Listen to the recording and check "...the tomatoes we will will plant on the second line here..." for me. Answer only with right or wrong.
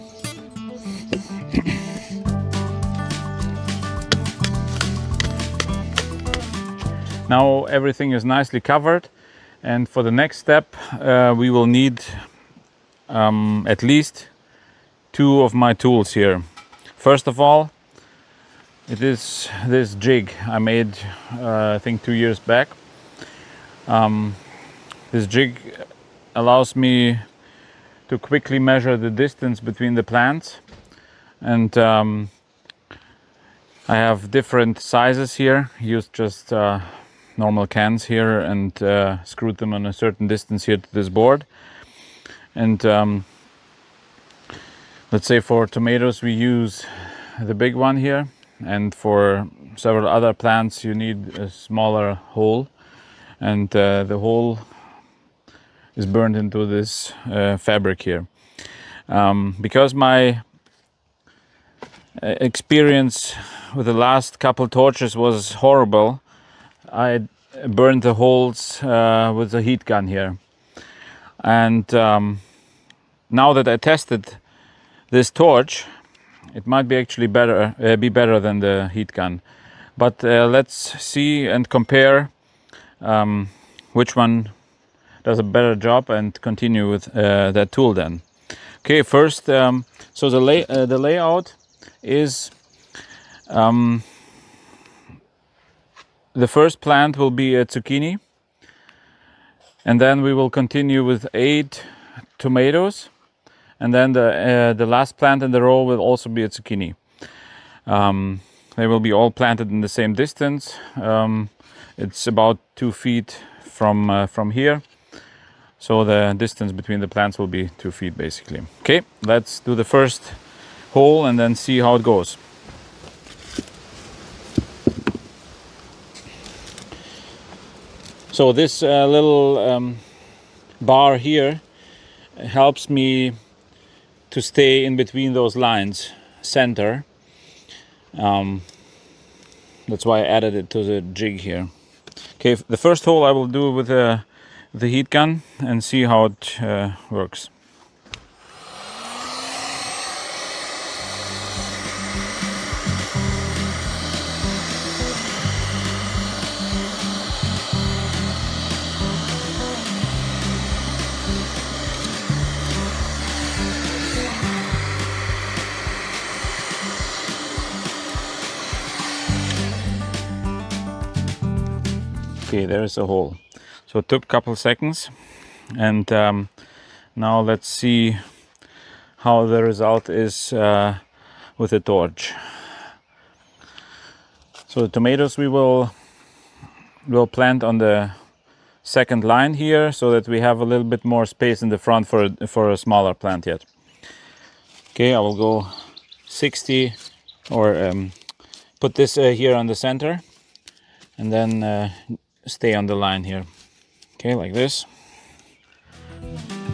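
right.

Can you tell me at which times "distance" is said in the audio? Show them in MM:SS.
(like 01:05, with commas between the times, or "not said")
00:29, 00:40, 01:50, 01:56.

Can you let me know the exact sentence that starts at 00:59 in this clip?
Um, because my uh, experience with the last couple torches was horrible, I burned the holes uh, with the heat gun here.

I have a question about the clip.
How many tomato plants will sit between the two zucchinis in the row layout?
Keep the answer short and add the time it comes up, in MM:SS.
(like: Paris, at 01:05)
8, at 01:41.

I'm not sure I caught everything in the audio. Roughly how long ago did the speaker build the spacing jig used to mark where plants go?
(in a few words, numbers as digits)
2 years.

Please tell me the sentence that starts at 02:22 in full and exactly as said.
Okay, the first hole I will do with uh, the heat gun and see how it uh, works.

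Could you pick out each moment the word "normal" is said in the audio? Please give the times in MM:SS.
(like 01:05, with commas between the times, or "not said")
00:37.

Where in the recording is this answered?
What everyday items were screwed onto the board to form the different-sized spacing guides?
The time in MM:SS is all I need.
00:37.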